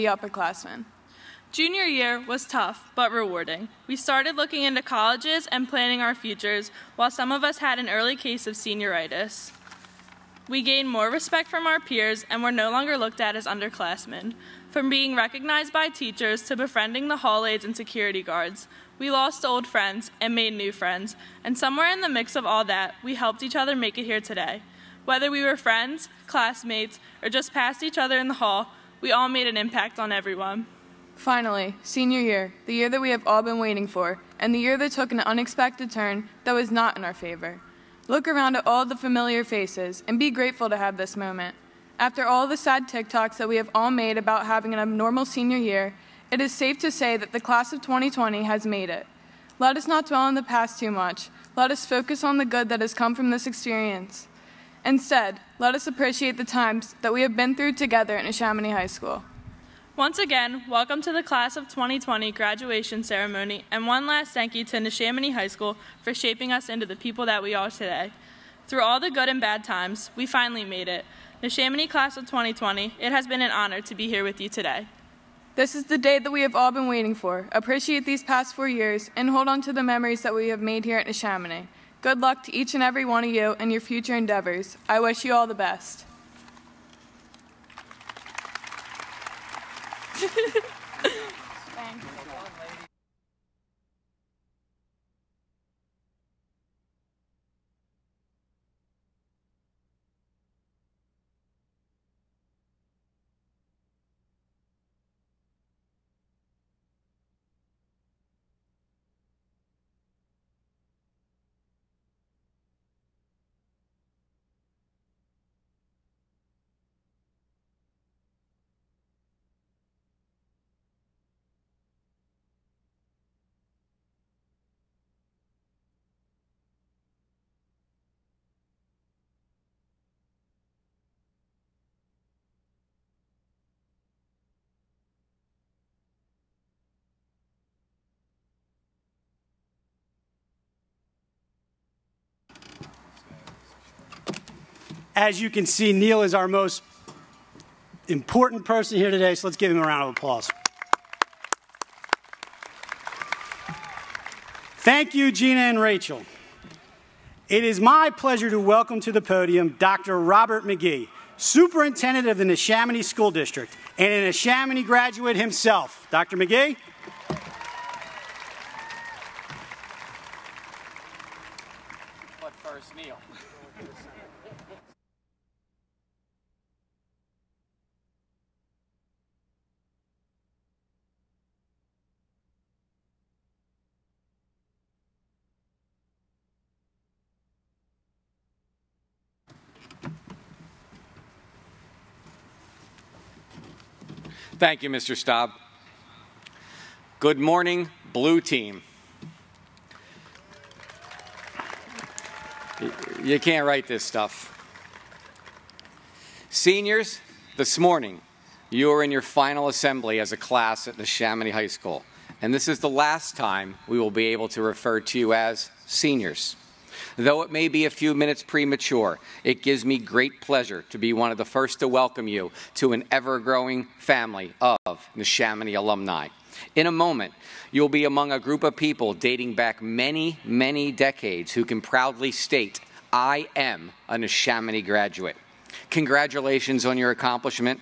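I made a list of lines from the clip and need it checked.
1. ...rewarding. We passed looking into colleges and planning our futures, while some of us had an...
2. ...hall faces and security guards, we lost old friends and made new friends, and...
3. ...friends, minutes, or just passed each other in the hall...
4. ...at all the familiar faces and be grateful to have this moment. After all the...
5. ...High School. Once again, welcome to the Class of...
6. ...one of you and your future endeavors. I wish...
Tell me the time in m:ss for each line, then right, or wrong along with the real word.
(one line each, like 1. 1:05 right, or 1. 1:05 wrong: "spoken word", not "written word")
1. 0:03 wrong: "started", not "passed"
2. 0:17 wrong: "aides", not "faces"
3. 0:25 wrong: "classmates", not "minutes"
4. 0:38 right
5. 0:58 right
6. 1:23 right.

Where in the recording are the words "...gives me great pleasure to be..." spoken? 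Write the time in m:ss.
3:39.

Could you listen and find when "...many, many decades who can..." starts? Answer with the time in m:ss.
3:49.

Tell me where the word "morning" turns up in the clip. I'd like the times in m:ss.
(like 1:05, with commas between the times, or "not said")
3:17, 3:27.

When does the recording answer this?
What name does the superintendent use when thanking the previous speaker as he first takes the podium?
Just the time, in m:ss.
3:14.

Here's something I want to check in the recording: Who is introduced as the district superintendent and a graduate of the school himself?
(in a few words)
Dr. Robert McGee.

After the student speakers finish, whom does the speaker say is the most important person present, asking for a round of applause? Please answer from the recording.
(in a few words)
Neil.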